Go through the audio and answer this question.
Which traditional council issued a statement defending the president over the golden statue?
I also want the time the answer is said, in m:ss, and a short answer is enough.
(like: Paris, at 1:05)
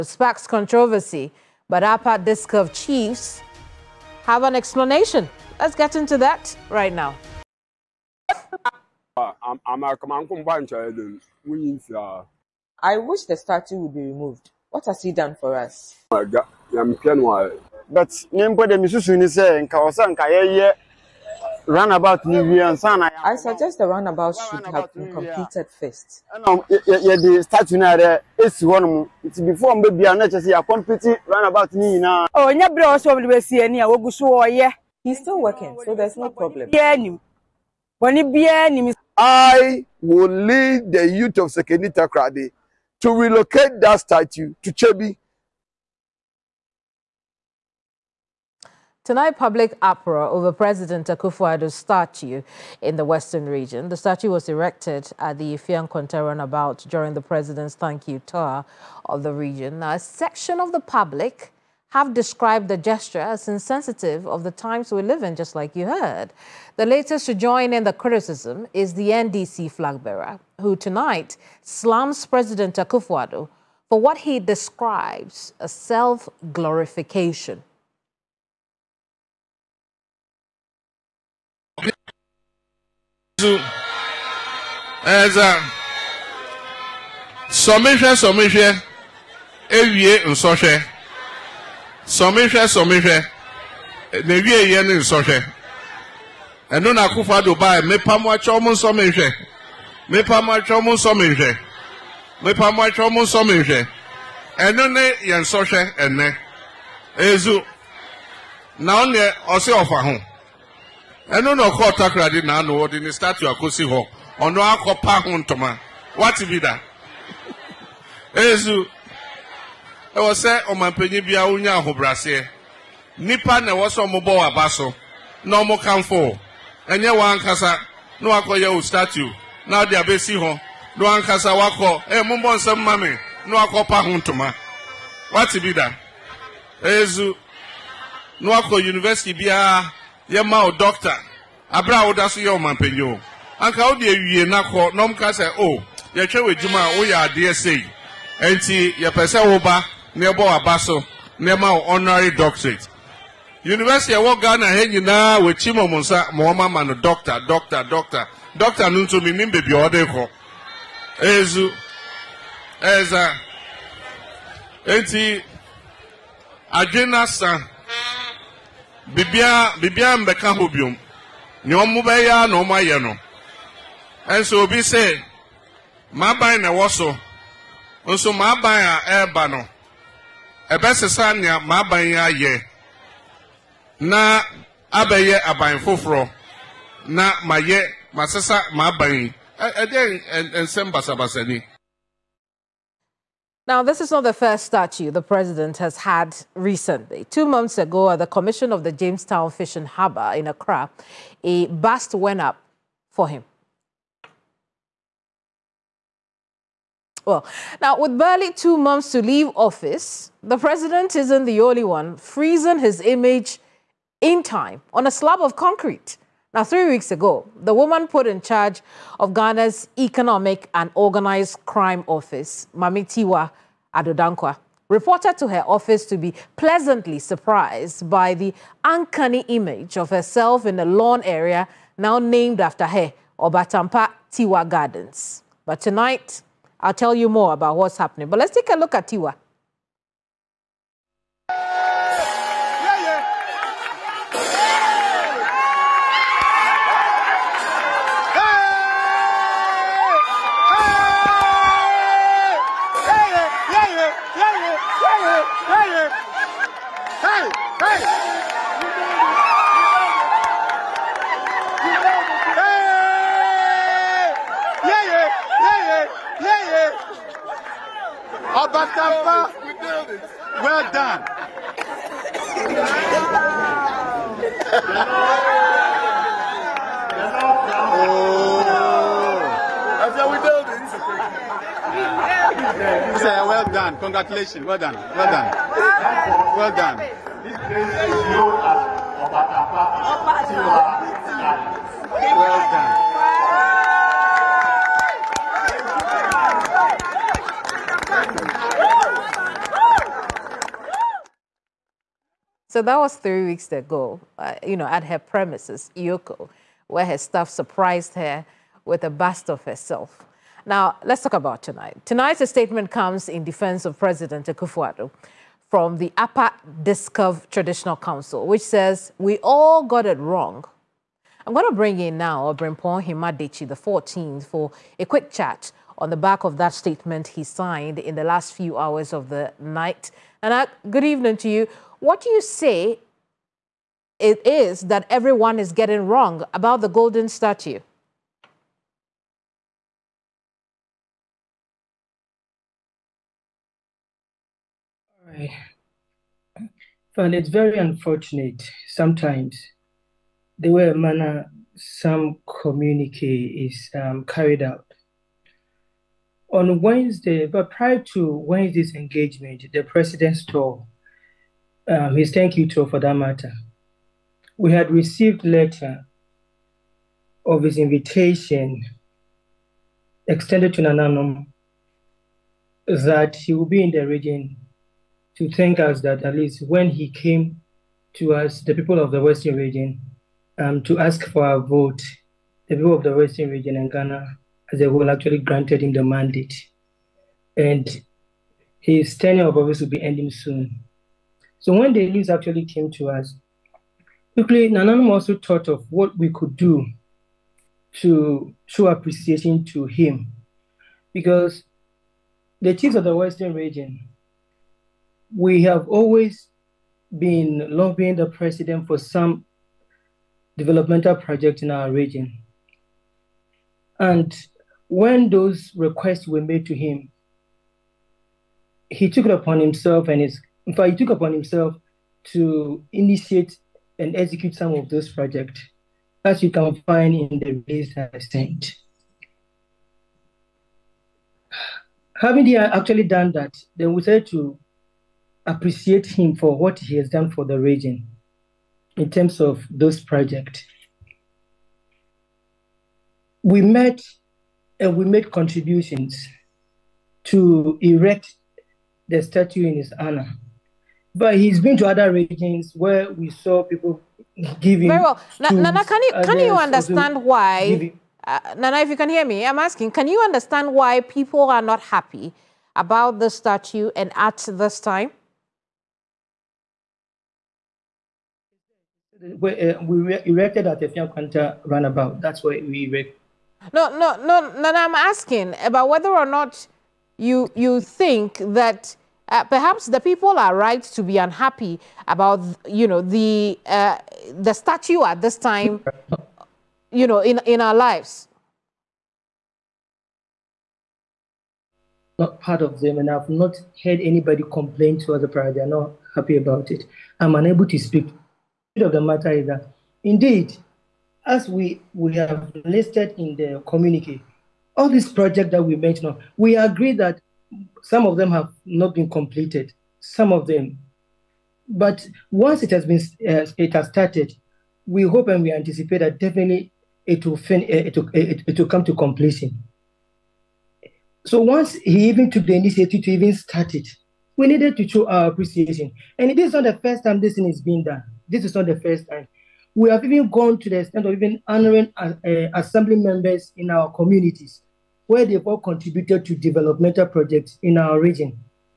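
Upper Dixcove Traditional Council, at 5:16.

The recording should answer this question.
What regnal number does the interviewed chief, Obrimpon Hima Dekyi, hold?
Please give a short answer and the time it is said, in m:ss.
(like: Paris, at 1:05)
14th, at 5:23.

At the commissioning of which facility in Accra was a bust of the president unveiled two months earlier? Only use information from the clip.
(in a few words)
Jamestown Fishing Harbor.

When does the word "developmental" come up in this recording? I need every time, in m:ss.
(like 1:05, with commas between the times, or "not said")
6:50, 8:56.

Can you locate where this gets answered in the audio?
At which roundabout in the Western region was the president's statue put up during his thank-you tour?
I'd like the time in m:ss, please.
0:55.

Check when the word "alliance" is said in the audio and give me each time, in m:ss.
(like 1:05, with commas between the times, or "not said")
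not said.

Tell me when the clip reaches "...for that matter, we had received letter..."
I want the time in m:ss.
6:02.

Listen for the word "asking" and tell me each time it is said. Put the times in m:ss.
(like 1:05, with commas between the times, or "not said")
7:39, 7:54.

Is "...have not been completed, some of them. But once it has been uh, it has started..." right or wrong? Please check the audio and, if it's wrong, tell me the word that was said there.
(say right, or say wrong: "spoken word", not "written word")
right.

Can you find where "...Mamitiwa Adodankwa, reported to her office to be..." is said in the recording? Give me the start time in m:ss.
3:42.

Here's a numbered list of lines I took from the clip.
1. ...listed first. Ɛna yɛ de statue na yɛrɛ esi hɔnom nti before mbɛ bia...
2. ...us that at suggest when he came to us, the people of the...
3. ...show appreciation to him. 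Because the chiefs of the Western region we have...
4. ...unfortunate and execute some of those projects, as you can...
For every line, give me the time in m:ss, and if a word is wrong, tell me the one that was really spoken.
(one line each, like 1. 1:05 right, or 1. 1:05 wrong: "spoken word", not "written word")
1. 0:25 wrong: "completed", not "listed"
2. 6:15 wrong: "least", not "suggest"
3. 6:38 right
4. 7:02 wrong: "initiate", not "unfortunate".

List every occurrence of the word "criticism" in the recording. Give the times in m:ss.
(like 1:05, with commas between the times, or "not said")
1:07.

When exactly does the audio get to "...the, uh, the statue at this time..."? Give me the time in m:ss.
8:03.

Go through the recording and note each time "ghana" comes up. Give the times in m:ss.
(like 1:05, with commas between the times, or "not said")
2:34, 3:39, 6:23.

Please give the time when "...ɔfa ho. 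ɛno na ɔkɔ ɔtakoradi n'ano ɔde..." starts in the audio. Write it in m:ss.
1:49.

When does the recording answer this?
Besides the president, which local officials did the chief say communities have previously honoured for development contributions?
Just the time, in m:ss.
8:52.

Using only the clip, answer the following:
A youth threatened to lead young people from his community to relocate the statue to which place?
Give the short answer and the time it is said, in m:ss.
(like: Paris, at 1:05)
Chebi, at 0:44.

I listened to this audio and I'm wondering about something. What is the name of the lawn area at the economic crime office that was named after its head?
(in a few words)
Obatampa Tiwaa Gardens.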